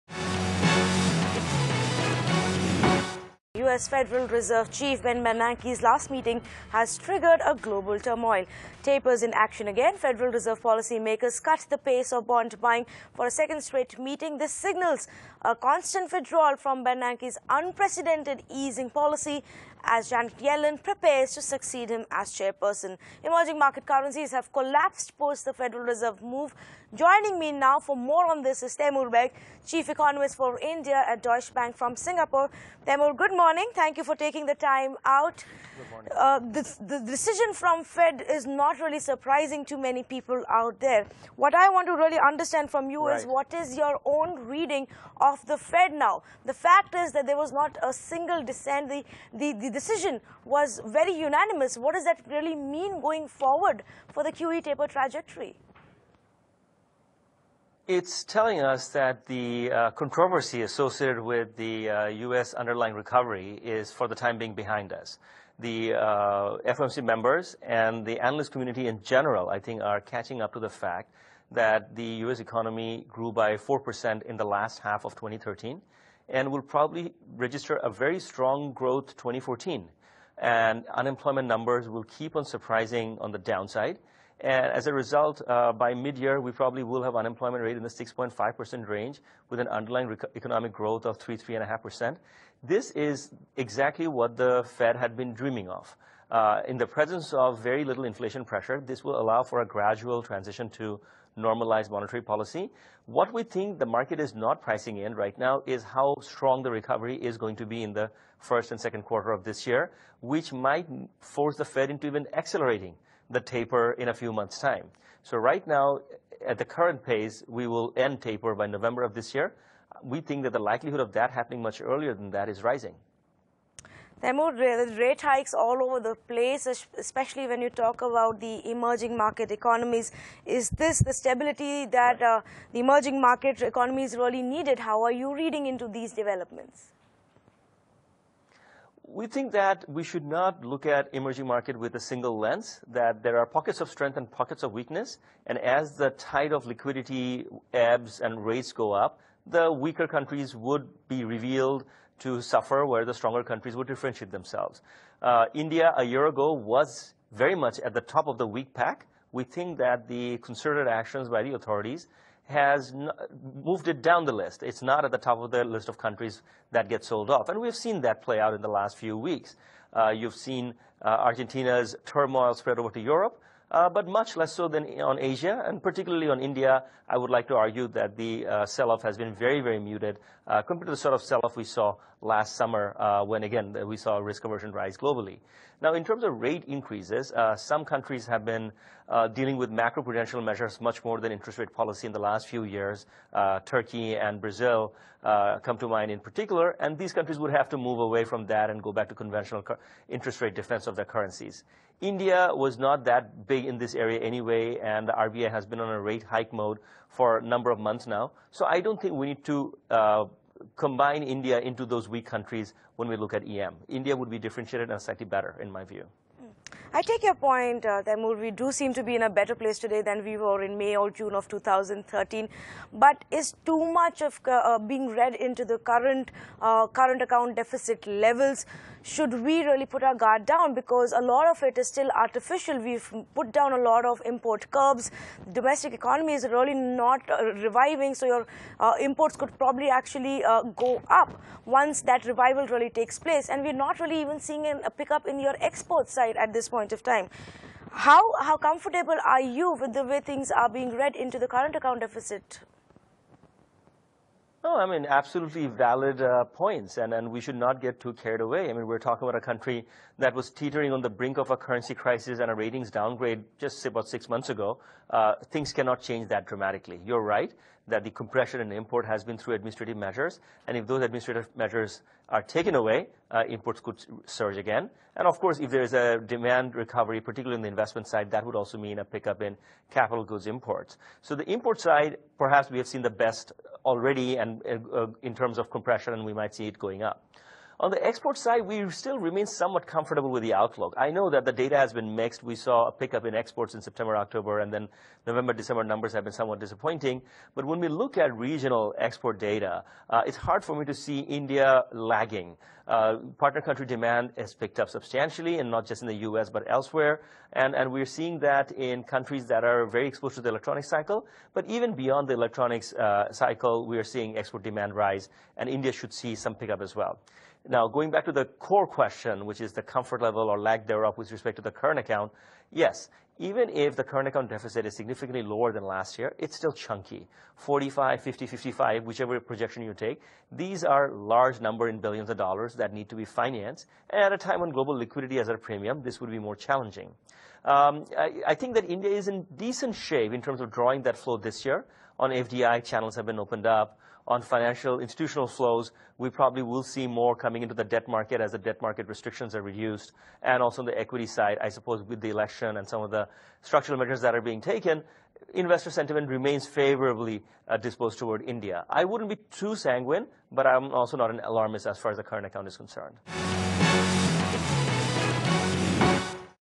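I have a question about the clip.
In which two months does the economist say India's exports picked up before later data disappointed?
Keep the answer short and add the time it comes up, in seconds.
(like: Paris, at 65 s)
September, October, at 293 s.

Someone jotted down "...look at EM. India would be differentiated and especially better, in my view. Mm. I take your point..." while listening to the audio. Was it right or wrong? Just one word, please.
wrong.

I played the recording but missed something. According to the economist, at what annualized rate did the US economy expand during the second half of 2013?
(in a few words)
4%.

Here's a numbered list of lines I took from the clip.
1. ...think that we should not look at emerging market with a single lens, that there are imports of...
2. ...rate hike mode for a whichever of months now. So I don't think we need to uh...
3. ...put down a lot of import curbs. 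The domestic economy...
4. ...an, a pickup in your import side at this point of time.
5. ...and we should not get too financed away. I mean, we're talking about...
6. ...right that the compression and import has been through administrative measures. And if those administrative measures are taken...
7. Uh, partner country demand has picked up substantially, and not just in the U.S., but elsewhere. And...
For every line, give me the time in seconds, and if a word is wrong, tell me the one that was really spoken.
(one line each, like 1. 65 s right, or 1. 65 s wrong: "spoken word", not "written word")
1. 139 s wrong: "pockets", not "imports"
2. 206 s wrong: "number", not "whichever"
3. 233 s right
4. 244 s wrong: "export", not "import"
5. 257 s wrong: "carried", not "financed"
6. 267 s right
7. 302 s right.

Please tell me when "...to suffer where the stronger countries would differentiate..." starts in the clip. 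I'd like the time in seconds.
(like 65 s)
152 s.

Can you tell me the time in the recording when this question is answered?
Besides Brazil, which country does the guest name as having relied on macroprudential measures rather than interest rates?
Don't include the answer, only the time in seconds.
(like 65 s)
193 s.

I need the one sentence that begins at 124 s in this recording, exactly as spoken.
There are more rate hikes all over the place, especially when you talk about the emerging market economies.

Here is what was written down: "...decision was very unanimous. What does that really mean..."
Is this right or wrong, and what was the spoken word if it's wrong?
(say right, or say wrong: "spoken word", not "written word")
right.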